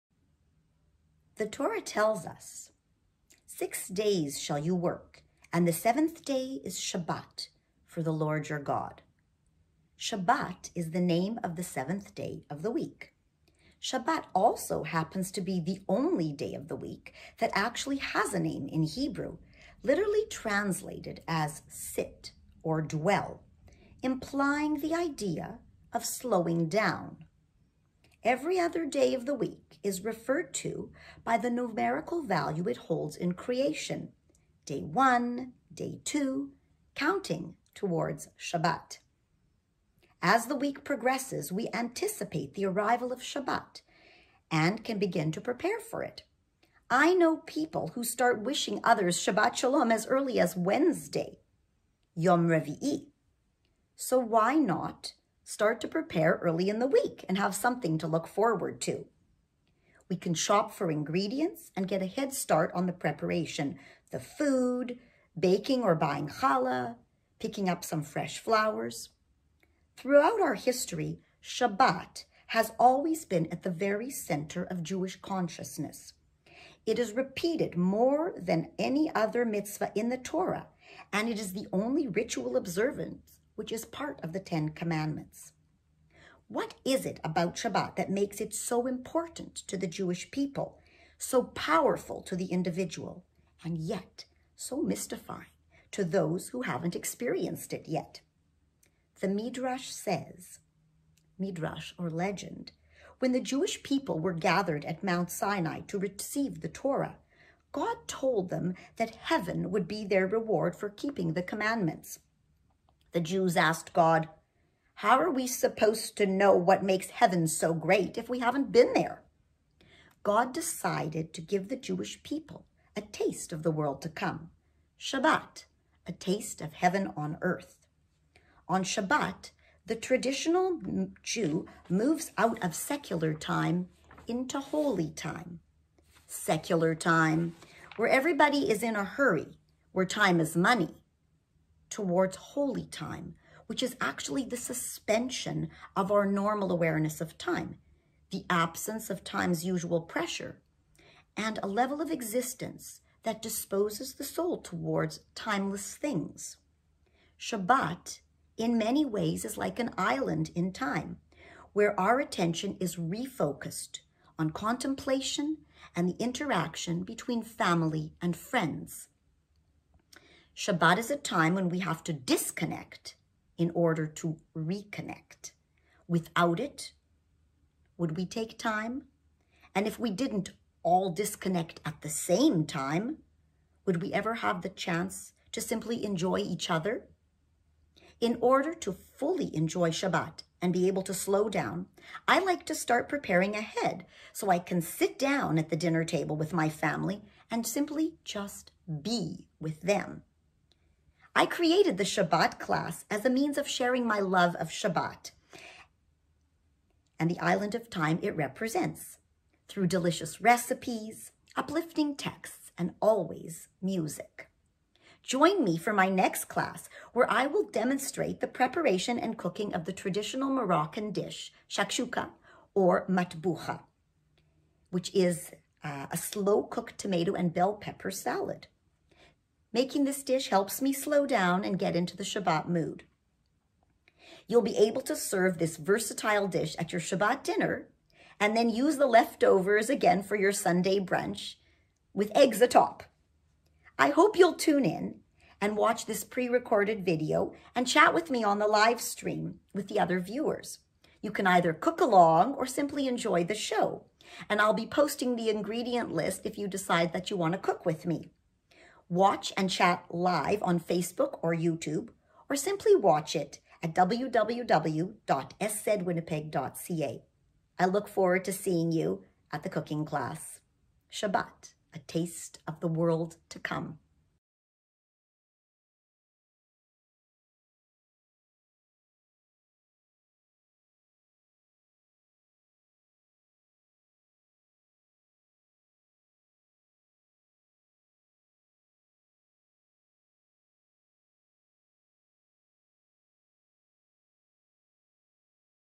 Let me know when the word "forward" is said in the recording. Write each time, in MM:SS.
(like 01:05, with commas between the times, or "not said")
00:58, 04:28.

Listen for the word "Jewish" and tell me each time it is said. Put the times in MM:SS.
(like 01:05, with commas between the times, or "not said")
01:14, 01:29, 01:43, 02:01.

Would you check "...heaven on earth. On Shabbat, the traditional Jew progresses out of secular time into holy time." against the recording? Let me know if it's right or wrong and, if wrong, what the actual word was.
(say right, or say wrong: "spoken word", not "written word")
wrong: "moves", not "progresses".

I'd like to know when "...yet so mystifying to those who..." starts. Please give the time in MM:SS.
01:33.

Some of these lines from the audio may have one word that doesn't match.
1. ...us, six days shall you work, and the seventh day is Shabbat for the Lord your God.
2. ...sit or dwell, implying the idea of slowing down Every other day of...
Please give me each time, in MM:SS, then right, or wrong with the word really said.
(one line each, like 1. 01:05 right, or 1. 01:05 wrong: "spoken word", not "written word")
1. 00:02 right
2. 00:21 right.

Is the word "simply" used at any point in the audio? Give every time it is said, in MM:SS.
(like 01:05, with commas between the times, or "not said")
03:05, 03:17, 04:12, 04:22.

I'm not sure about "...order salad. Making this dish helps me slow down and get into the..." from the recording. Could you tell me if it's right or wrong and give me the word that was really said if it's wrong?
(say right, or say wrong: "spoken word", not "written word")
wrong: "pepper", not "order".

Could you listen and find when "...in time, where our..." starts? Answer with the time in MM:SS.
02:40.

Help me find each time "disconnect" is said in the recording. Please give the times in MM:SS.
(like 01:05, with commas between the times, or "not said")
02:52, 03:01.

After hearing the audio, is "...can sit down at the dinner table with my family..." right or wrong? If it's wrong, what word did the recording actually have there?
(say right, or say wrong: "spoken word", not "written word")
right.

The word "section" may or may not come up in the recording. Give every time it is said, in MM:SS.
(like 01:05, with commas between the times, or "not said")
not said.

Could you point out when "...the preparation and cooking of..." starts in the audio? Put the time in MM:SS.
03:38.